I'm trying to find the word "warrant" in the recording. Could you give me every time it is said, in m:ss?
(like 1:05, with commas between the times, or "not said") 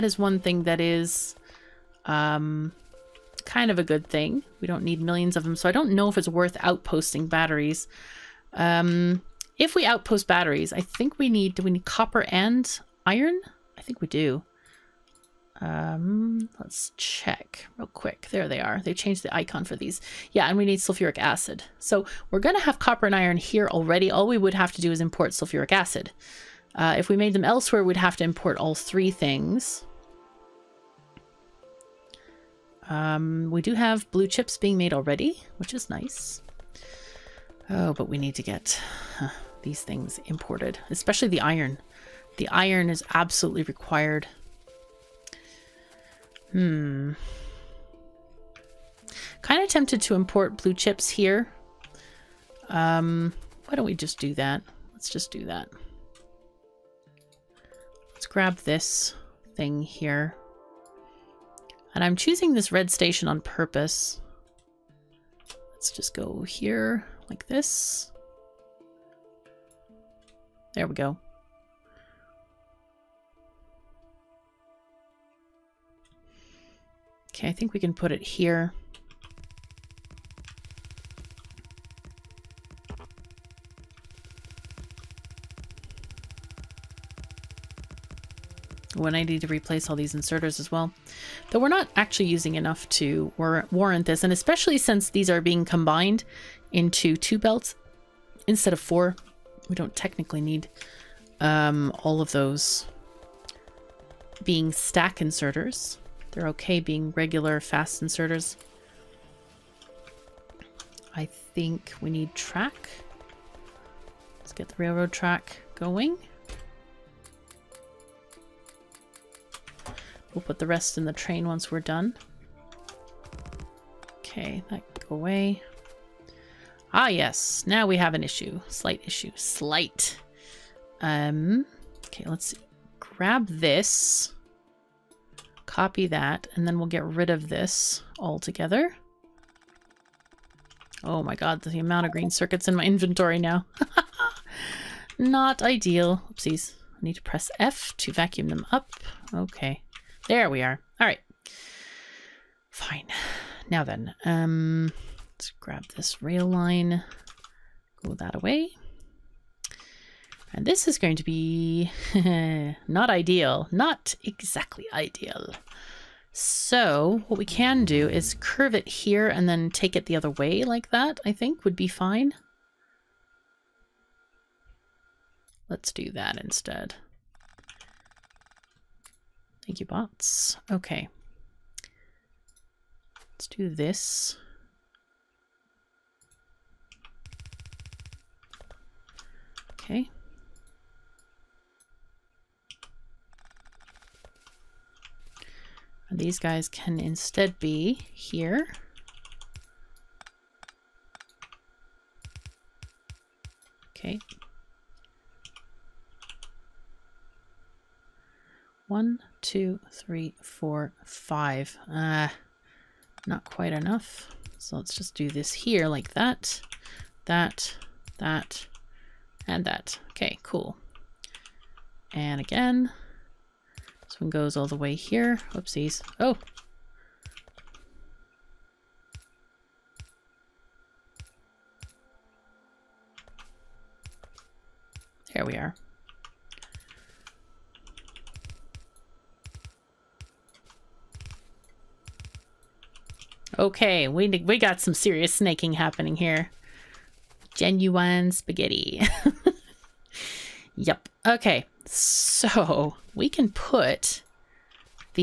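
1:33.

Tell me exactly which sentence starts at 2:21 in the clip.
Oh my god, the amount of green circuits in my inventory now.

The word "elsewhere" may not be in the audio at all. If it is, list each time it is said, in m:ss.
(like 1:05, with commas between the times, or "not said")
0:27.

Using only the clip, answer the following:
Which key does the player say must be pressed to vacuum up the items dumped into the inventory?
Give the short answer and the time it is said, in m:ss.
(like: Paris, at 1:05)
F, at 2:27.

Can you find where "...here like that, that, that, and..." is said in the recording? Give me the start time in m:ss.
3:35.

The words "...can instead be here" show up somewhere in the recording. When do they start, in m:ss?
3:16.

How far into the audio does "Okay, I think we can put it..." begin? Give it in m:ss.
1:17.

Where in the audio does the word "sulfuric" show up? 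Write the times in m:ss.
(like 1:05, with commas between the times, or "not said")
0:20, 0:25.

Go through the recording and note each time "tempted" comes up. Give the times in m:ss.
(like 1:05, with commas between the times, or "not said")
0:49.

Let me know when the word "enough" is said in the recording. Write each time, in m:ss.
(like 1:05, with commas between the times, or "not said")
1:32, 3:33.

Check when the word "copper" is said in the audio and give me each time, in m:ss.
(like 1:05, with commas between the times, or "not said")
0:11, 0:22.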